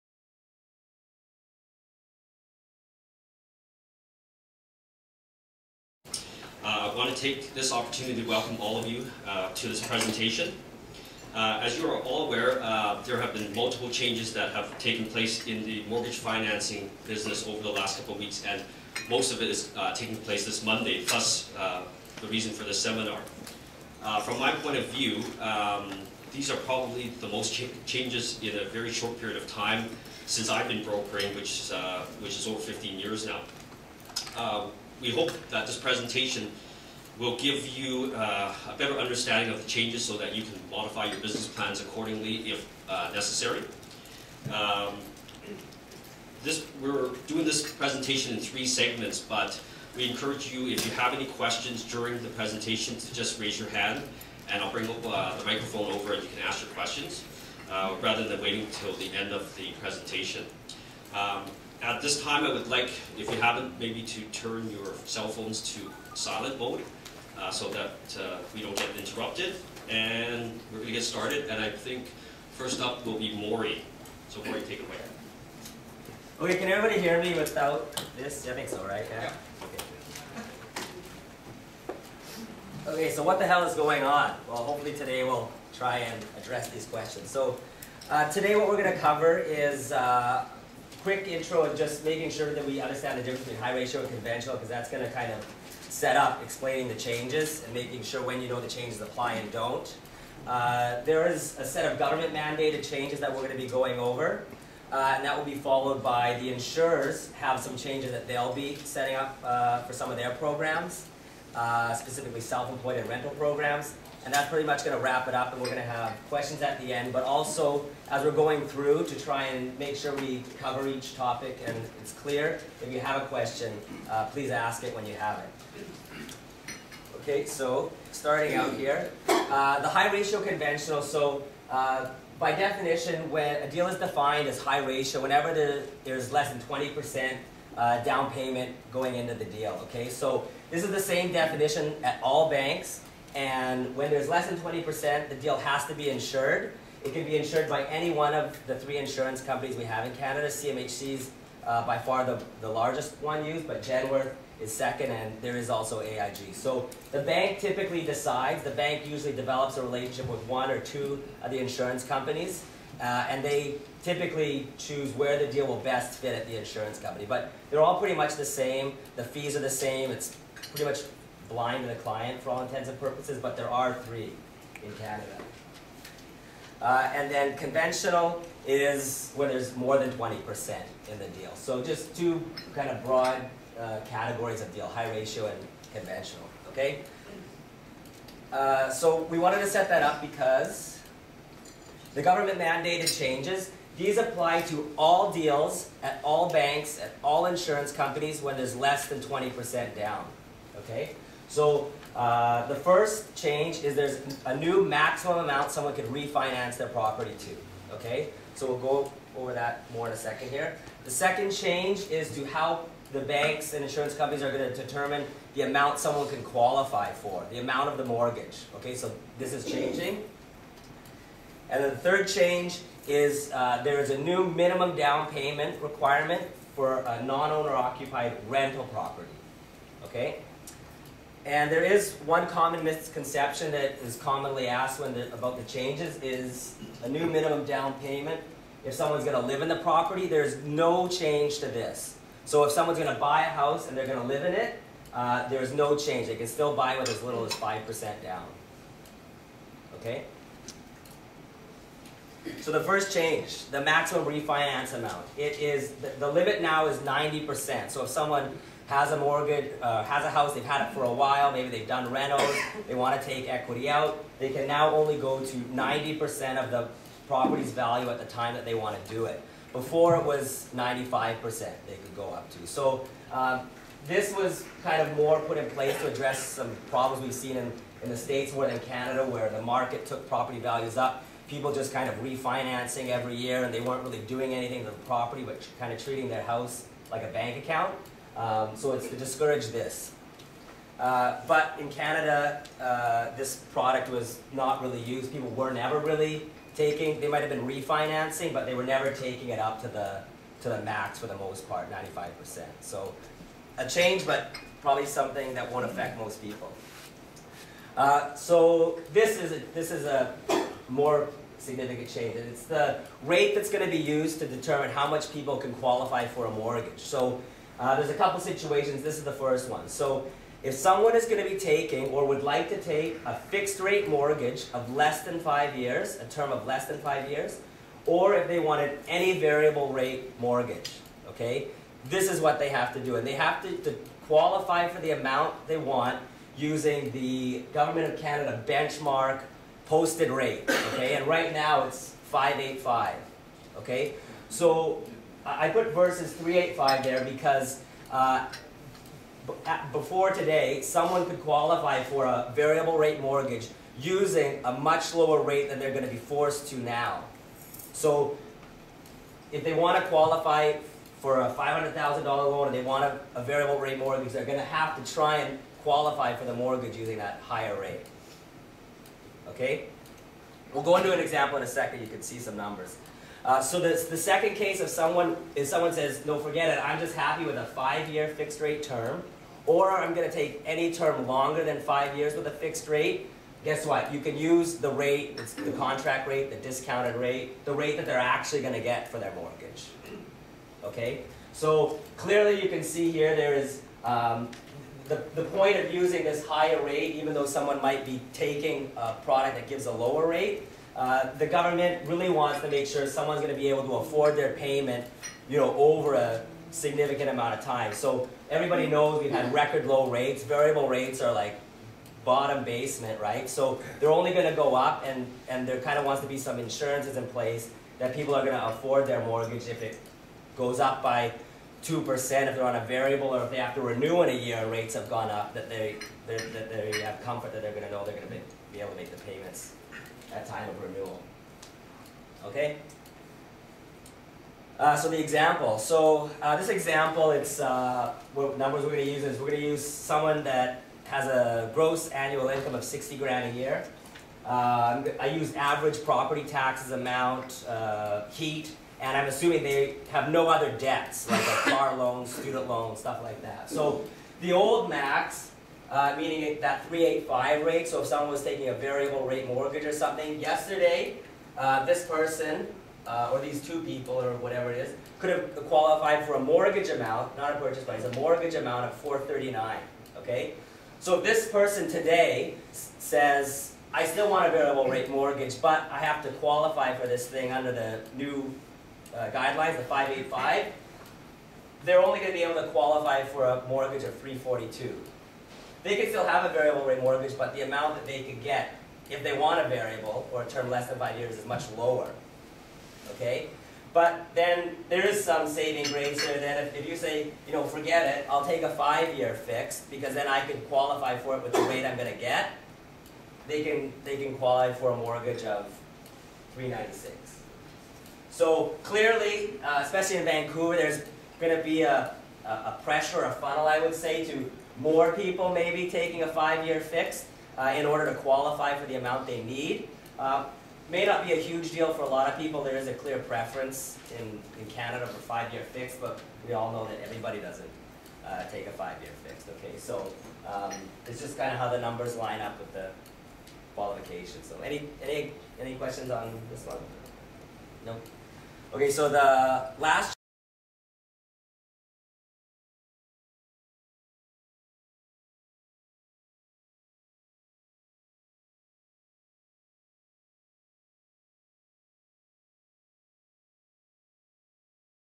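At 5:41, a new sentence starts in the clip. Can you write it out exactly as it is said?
And right now it's 585, okay?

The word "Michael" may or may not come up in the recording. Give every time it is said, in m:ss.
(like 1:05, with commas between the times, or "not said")
not said.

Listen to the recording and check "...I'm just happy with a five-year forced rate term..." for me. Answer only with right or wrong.
wrong.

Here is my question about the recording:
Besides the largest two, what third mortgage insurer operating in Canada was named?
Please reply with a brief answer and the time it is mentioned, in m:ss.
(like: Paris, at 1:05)
AIG, at 2:36.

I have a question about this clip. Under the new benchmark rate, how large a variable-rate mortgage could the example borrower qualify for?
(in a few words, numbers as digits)
342.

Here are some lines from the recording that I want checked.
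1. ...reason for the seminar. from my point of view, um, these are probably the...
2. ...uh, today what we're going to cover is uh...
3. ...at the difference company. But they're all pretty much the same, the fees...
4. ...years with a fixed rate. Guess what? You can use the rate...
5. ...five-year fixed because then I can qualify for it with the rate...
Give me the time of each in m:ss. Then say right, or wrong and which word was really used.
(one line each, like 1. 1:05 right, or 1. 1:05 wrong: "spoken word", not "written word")
1. 0:22 right
2. 1:28 right
3. 2:46 wrong: "insurance", not "difference"
4. 6:22 right
5. 8:18 right.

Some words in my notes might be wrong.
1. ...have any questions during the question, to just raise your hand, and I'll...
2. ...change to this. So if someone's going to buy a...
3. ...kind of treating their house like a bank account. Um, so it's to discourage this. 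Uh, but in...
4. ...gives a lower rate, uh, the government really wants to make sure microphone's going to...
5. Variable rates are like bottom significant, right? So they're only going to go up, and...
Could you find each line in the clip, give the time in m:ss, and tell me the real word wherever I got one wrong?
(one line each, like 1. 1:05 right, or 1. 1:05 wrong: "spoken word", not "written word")
1. 0:50 wrong: "presentation", not "question"
2. 4:01 right
3. 4:45 right
4. 6:39 wrong: "someone", not "microphone"
5. 6:50 wrong: "basement", not "significant".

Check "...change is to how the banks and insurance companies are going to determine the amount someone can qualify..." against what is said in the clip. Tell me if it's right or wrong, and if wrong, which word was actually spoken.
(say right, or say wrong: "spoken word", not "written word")
right.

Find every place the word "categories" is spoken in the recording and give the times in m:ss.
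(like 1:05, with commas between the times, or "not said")
3:04.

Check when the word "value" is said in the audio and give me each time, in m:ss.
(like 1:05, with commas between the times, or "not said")
4:27, 4:40.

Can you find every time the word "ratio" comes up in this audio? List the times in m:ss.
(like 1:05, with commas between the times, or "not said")
1:33, 2:10, 2:14, 3:05.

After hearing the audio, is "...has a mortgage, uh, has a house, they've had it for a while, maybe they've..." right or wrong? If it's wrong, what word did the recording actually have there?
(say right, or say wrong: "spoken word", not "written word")
right.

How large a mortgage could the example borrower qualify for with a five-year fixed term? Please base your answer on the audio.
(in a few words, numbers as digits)
396.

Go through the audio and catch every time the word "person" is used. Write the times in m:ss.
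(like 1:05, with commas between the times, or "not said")
7:42, 7:51.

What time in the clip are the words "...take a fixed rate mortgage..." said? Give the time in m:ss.
5:22.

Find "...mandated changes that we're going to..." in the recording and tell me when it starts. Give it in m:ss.
1:42.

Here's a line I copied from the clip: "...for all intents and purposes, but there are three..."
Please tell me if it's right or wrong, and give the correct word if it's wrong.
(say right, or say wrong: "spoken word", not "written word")
right.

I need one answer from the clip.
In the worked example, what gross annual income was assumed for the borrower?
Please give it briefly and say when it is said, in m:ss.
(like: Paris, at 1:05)
$60,000, at 7:22.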